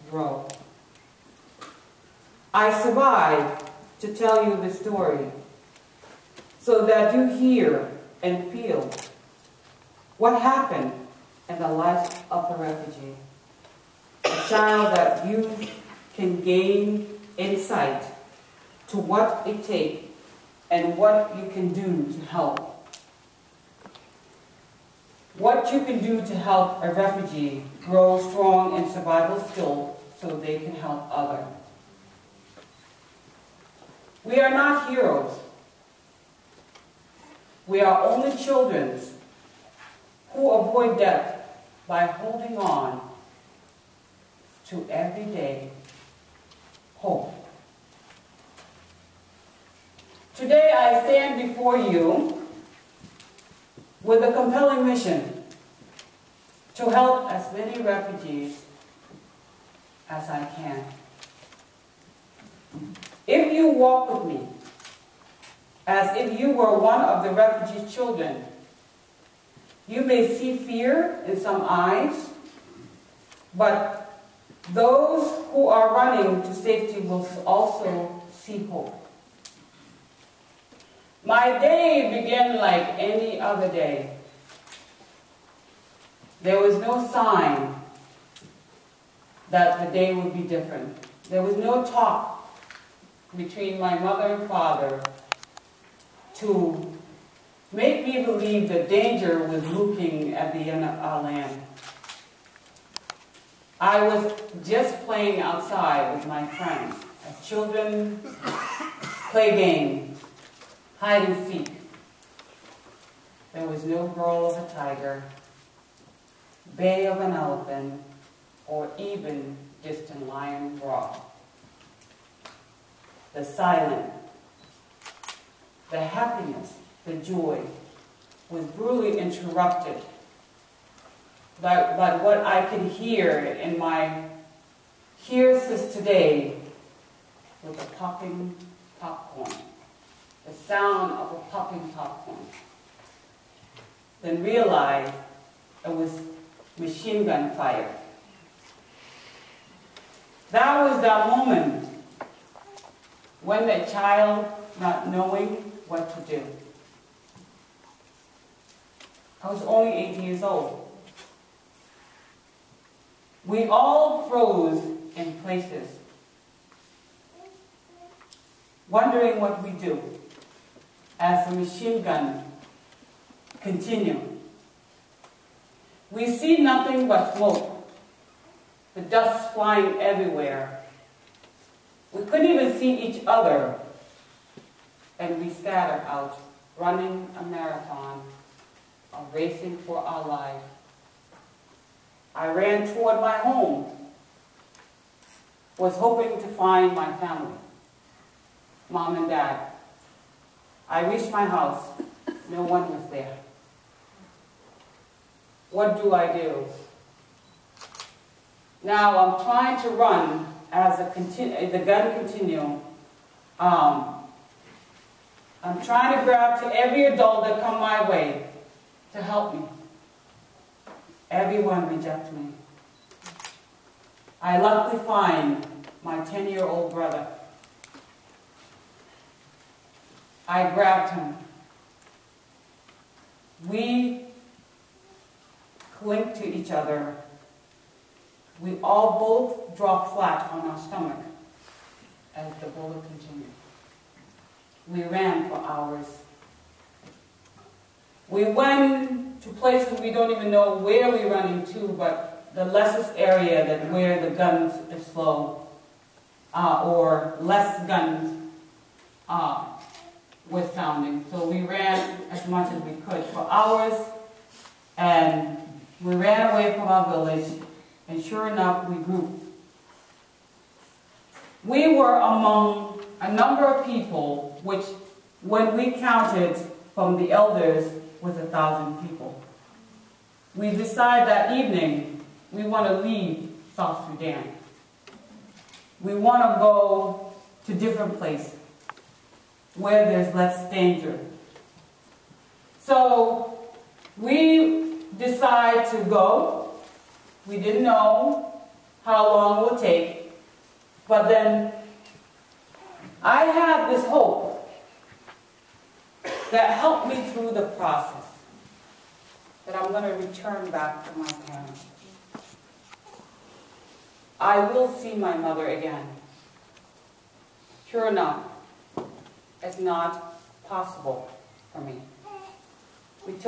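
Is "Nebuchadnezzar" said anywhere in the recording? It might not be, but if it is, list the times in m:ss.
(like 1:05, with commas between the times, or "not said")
not said.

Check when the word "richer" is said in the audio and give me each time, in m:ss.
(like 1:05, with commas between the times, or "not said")
not said.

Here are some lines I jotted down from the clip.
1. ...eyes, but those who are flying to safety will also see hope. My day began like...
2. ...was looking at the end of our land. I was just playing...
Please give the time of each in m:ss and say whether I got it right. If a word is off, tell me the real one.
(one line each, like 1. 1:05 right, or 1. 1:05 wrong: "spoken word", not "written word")
1. 1:11 wrong: "running", not "flying"
2. 1:39 right.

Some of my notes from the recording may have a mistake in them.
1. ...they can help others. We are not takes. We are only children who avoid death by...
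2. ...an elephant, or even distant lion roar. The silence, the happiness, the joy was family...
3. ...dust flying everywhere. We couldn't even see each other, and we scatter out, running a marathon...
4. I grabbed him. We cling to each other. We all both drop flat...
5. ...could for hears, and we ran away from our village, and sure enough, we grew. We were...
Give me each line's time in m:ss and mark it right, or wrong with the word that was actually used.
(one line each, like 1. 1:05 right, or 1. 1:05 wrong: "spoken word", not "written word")
1. 0:30 wrong: "heroes", not "takes"
2. 1:57 wrong: "brutally", not "family"
3. 2:59 right
4. 3:50 right
5. 4:23 wrong: "hours", not "hears".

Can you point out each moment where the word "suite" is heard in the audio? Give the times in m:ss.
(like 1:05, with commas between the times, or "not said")
not said.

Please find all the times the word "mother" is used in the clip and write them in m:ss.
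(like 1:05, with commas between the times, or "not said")
1:33, 5:15.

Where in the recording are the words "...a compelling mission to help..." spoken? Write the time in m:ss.
0:54.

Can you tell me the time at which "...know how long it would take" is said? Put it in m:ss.
4:57.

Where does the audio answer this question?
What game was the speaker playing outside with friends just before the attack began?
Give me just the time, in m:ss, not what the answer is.
1:50.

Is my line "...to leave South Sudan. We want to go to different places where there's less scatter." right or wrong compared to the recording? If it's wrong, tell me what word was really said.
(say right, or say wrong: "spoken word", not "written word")
wrong: "danger", not "scatter".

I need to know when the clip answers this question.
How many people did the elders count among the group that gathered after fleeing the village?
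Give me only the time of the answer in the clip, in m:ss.
4:38.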